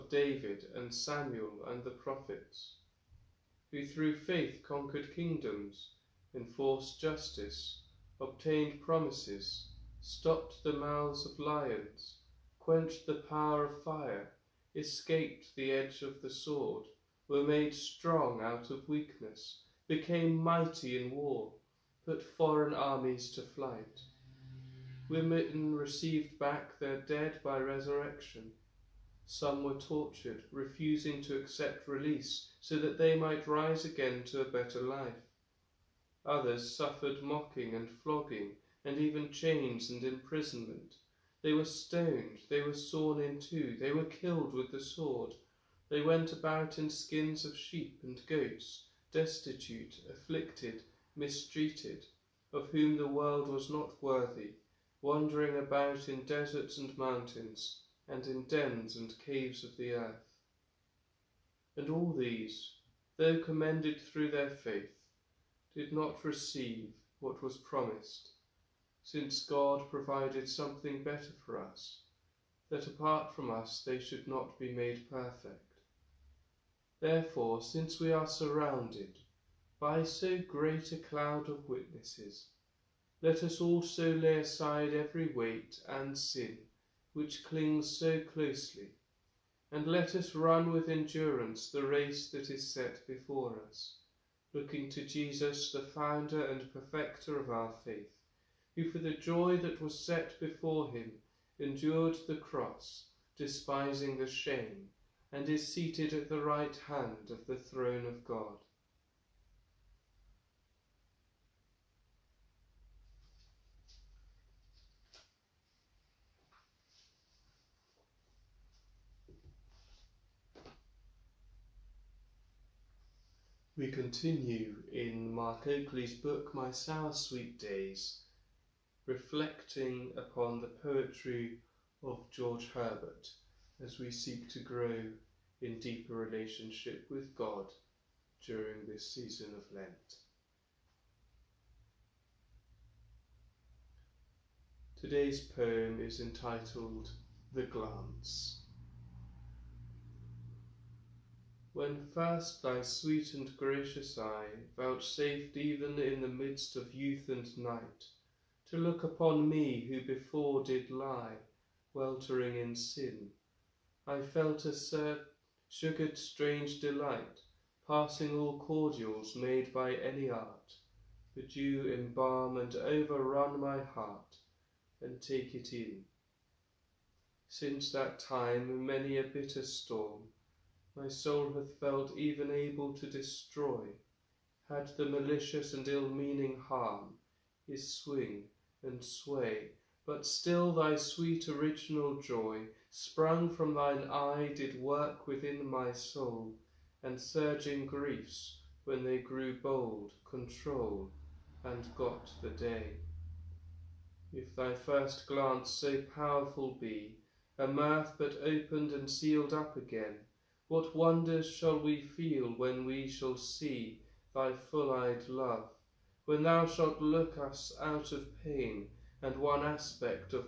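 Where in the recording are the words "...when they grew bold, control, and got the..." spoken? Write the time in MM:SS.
03:18.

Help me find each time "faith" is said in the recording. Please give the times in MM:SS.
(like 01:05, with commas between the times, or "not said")
00:04, 01:04, 01:37.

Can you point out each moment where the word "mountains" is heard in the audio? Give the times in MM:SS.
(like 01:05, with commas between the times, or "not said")
00:56.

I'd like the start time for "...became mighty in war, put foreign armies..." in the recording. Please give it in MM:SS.
00:19.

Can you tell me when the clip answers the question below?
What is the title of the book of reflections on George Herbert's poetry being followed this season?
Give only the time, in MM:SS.
02:06.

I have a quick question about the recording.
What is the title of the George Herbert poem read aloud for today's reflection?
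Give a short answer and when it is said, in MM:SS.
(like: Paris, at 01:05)
The Glance, at 02:27.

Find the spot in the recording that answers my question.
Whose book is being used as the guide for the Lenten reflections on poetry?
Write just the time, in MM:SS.
02:05.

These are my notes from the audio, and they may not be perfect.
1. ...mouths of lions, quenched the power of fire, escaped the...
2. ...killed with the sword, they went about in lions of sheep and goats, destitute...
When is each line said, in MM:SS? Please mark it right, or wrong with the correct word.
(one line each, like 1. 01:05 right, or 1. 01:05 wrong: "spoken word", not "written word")
1. 00:10 right
2. 00:44 wrong: "skins", not "lions".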